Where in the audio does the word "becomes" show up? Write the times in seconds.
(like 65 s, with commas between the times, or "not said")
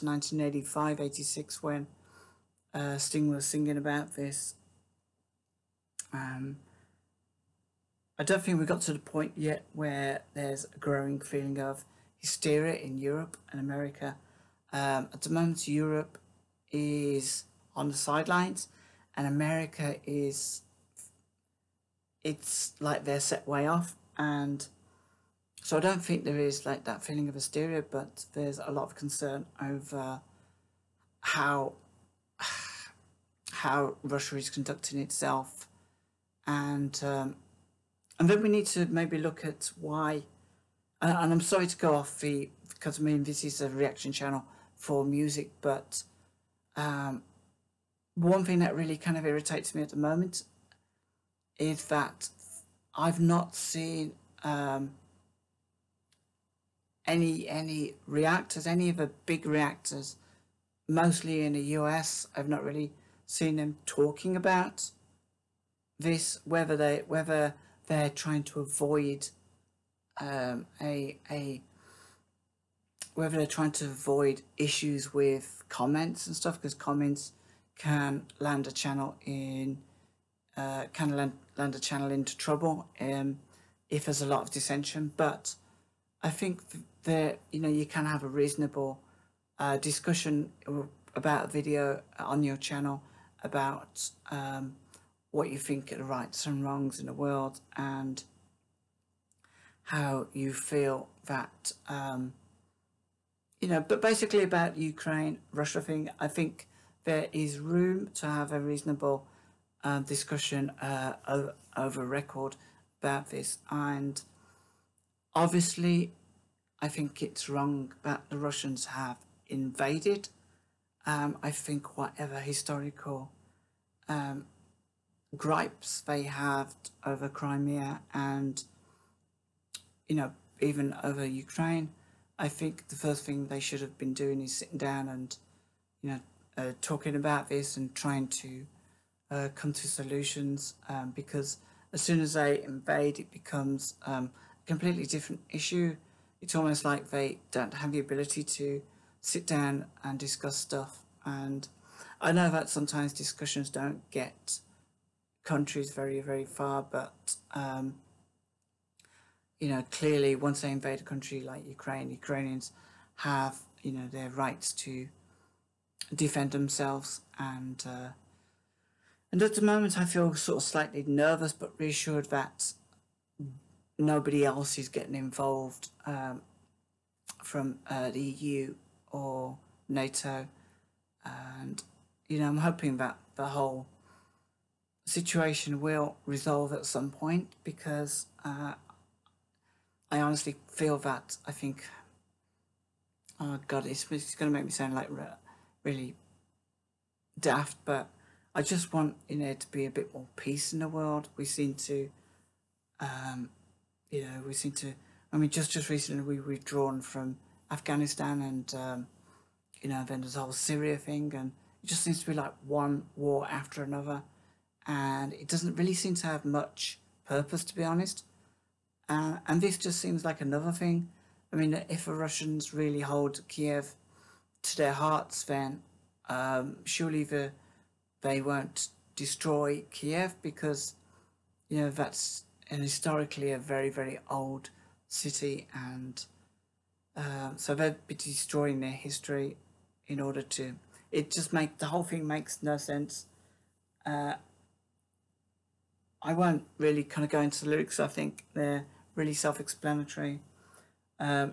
143 s.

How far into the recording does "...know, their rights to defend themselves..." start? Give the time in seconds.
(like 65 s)
163 s.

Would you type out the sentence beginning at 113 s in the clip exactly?
And obviously, I think it's wrong that the Russians have invaded.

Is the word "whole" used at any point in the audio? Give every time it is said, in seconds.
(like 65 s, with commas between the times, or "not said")
183 s, 210 s, 241 s.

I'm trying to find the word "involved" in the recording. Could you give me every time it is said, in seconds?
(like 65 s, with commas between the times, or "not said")
175 s.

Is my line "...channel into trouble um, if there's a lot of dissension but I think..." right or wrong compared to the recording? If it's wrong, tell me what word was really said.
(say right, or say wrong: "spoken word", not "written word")
right.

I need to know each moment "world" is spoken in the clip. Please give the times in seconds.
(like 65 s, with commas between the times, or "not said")
97 s, 200 s.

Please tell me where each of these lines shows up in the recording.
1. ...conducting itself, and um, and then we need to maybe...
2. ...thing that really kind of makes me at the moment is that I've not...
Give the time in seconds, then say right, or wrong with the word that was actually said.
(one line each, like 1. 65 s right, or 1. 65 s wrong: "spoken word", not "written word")
1. 34 s right
2. 48 s wrong: "irritates", not "makes".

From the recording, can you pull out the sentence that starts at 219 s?
Uh, and this just seems like another thing.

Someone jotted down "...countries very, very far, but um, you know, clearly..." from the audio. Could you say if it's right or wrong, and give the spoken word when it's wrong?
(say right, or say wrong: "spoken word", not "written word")
right.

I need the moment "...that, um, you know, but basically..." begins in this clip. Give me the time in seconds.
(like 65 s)
101 s.